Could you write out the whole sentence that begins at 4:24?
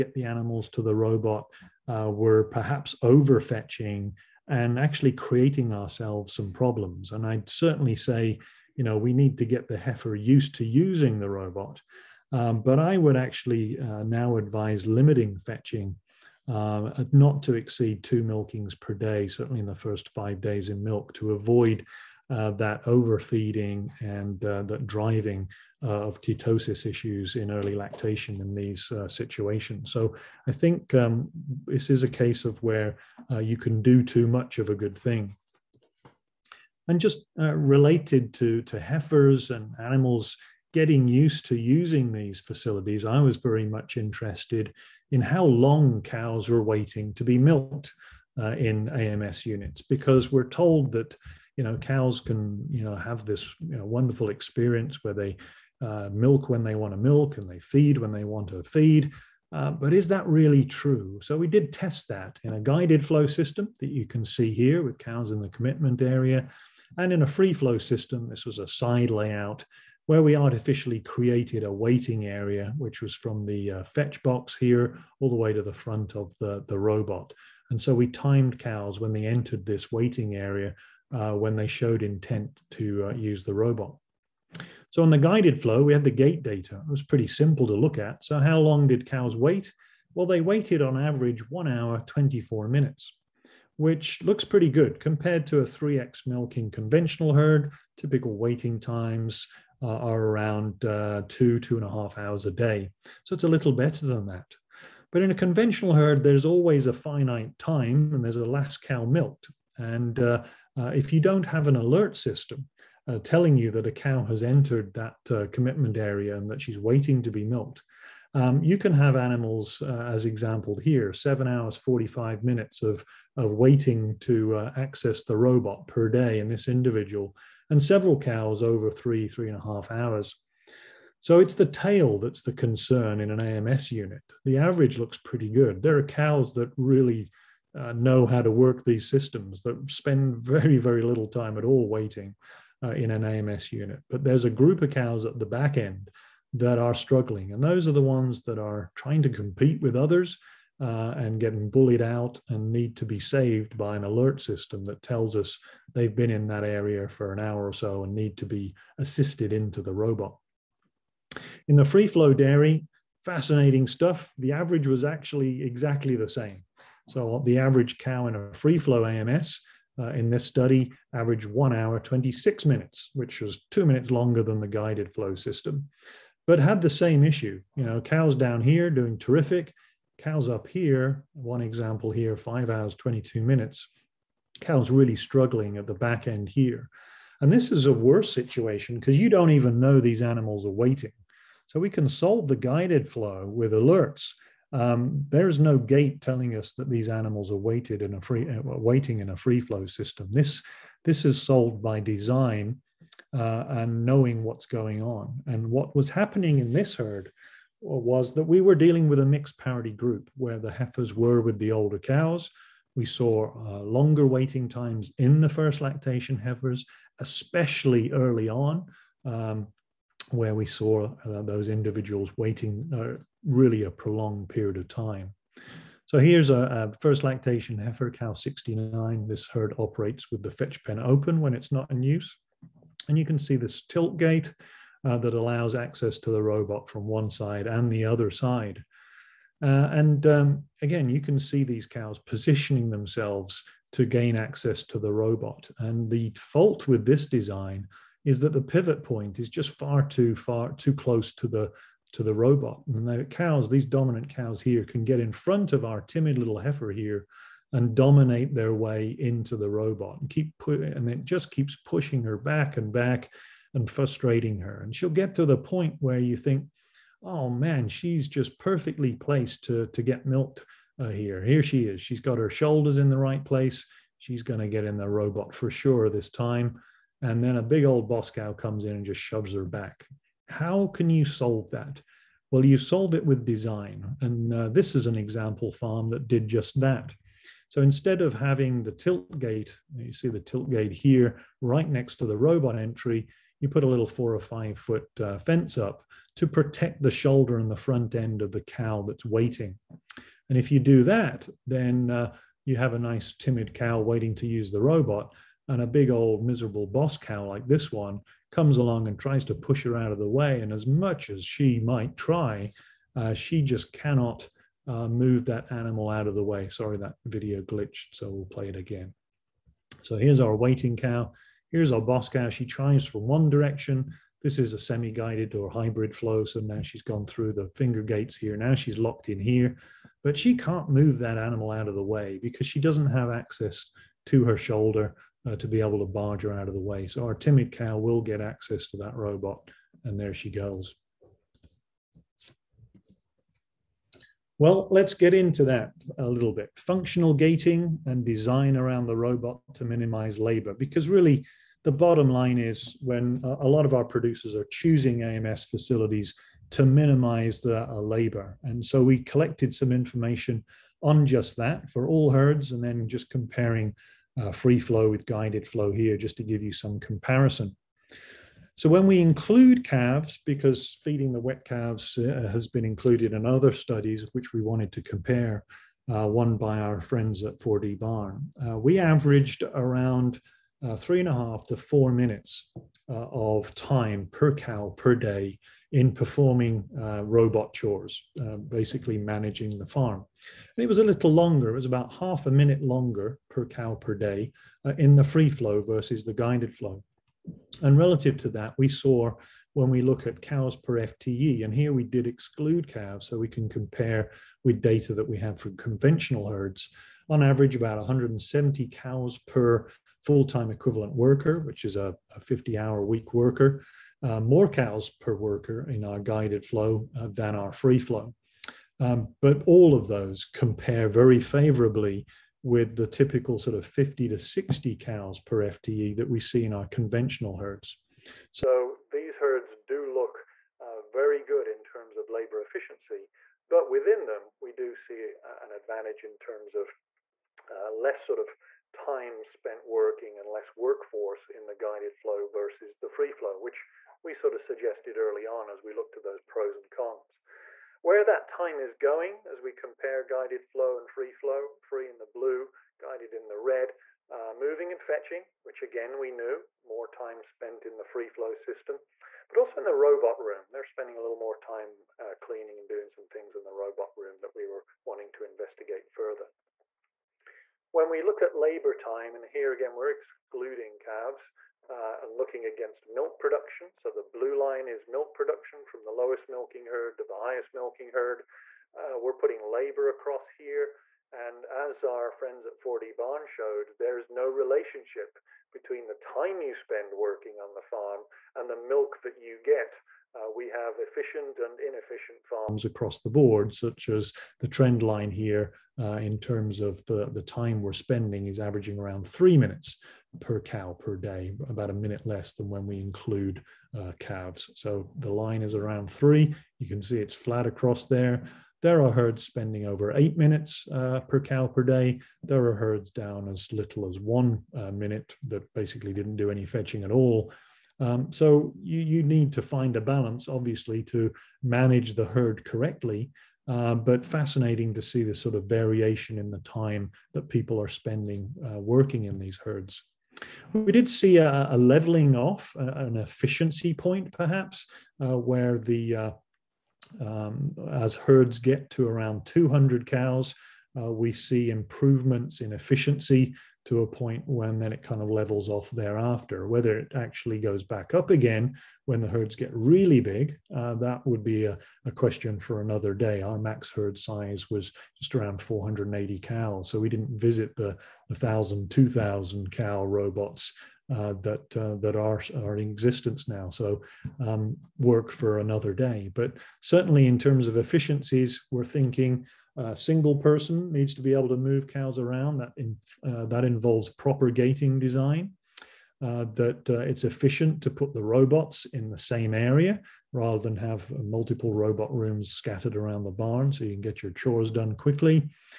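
And she'll get to the point where you think, oh man, she's just perfectly placed to, to get milked uh, here.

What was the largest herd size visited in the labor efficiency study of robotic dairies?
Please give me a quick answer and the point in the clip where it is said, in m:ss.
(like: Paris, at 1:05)
480 cows, at 9:15.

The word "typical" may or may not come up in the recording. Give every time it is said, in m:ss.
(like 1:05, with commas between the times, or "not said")
1:37, 7:03.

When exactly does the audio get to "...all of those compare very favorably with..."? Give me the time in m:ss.
6:59.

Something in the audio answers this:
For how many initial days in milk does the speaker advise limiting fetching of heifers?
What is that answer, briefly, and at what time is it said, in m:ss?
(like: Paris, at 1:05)
5, at 0:19.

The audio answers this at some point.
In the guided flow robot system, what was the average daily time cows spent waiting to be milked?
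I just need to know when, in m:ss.
1:31.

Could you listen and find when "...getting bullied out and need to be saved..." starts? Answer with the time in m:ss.
2:31.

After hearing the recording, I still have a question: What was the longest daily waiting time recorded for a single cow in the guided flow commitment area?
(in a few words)
7 hours 45 minutes.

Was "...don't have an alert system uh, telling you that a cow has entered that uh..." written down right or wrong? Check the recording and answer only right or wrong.
right.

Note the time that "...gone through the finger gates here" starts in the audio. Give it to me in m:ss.
5:27.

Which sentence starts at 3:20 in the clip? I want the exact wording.
This, this is solved by design uh, and knowing what's going on.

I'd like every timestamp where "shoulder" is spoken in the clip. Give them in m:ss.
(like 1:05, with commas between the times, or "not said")
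4:32, 4:57, 5:34.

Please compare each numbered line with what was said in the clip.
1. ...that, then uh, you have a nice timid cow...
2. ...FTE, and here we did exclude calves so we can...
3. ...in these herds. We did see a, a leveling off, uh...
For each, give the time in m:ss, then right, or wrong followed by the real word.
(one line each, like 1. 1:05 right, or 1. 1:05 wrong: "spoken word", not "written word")
1. 5:01 right
2. 6:40 right
3. 8:49 right.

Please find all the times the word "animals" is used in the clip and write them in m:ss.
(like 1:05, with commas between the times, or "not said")
0:00, 0:39, 1:59, 3:10, 3:17, 5:15, 5:31.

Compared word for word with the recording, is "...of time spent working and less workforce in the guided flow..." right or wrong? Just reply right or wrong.
right.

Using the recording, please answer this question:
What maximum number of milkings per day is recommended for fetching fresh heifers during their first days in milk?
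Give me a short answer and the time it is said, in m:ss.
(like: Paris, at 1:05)
2, at 0:18.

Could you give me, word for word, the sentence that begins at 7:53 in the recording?
So the blue line is milk production from the lowest milking herd to the highest milking herd.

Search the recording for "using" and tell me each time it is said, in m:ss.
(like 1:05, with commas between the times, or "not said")
0:10, 0:41.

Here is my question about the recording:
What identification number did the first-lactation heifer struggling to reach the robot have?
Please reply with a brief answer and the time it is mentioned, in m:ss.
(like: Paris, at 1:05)
69, at 3:48.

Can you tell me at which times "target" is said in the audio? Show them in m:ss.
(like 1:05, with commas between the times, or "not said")
not said.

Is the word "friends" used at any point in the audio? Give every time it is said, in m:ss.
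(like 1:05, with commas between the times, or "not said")
6:17, 8:02.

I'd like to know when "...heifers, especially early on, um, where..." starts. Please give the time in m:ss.
3:36.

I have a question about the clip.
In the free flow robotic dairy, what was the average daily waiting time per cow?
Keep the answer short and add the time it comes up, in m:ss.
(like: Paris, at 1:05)
1 hour 26 minutes, at 2:51.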